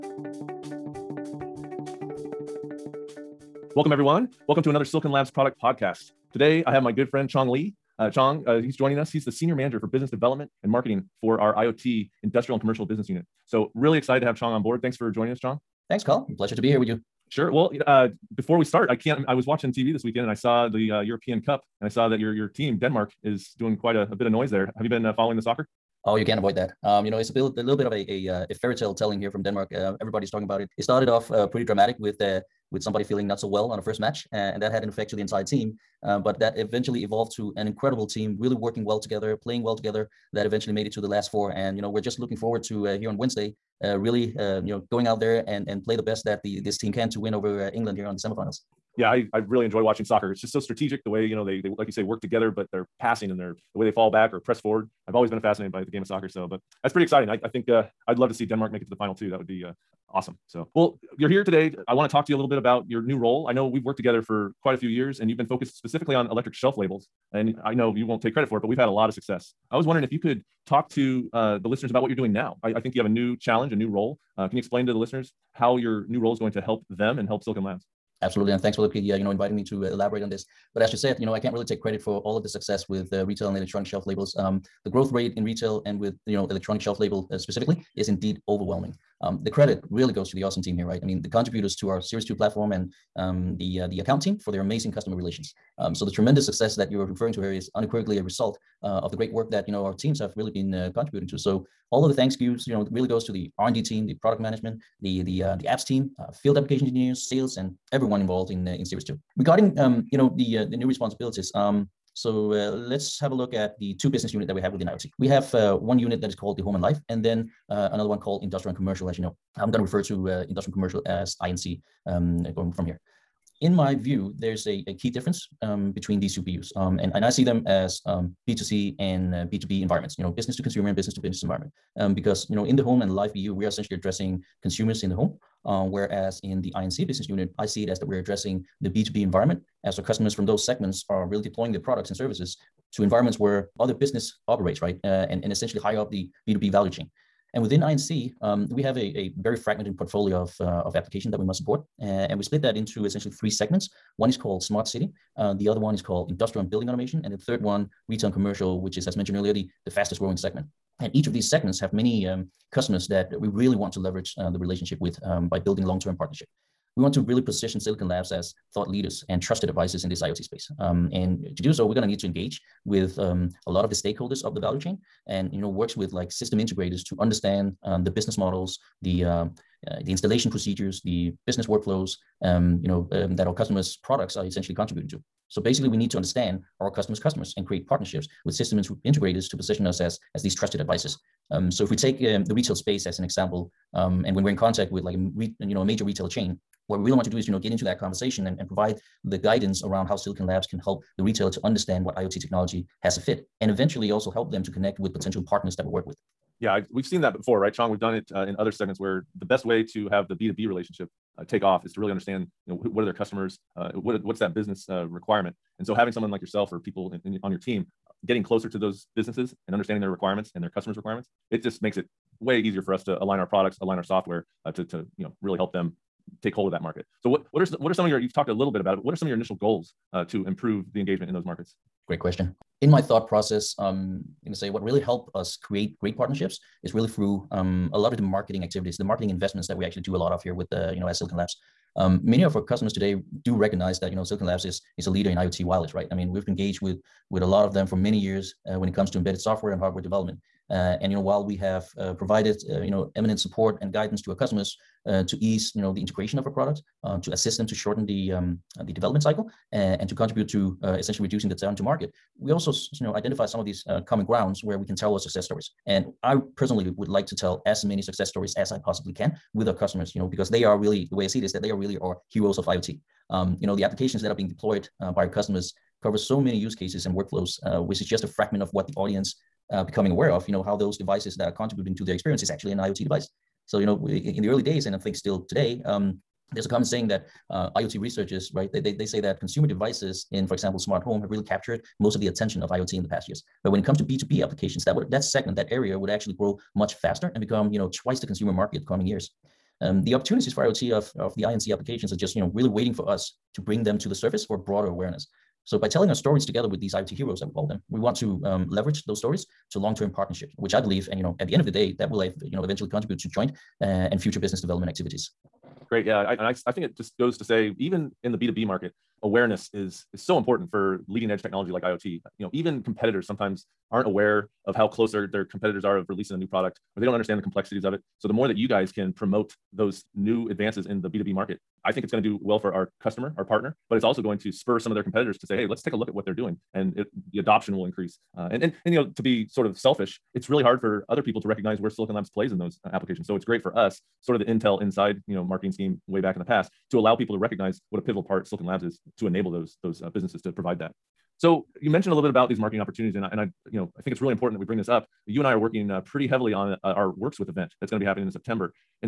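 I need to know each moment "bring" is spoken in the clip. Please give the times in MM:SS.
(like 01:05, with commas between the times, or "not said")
05:03, 05:54.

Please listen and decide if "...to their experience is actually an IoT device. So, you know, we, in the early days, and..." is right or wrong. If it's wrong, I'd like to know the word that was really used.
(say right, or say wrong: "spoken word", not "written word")
right.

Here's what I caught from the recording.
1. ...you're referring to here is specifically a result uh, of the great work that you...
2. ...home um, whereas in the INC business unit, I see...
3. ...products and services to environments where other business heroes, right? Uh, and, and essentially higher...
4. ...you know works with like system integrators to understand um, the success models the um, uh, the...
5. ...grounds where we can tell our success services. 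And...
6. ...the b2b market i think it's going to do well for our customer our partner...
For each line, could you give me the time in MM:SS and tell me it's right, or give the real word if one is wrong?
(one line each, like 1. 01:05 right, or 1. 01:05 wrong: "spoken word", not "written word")
1. 01:36 wrong: "unequivocally", not "specifically"
2. 02:15 right
3. 02:21 wrong: "operates", not "heroes"
4. 02:55 wrong: "business", not "success"
5. 04:24 wrong: "stories", not "services"
6. 05:31 right.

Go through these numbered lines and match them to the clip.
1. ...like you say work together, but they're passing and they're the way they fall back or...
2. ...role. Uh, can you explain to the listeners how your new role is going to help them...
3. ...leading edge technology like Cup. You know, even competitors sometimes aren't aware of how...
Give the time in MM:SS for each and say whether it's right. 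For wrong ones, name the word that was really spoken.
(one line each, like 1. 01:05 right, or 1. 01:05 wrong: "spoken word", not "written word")
1. 00:51 right
2. 01:13 right
3. 05:21 wrong: "IoT", not "Cup".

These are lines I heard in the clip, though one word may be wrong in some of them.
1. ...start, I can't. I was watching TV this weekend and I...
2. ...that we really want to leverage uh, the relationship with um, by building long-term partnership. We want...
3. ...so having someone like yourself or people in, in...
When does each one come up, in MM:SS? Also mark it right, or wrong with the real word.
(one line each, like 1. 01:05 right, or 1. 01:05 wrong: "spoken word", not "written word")
1. 00:18 right
2. 02:43 right
3. 03:35 right.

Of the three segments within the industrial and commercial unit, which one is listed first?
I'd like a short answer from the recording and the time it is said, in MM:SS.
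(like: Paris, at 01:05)
Smart City, at 02:34.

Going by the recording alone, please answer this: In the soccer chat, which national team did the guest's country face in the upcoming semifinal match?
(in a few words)
England.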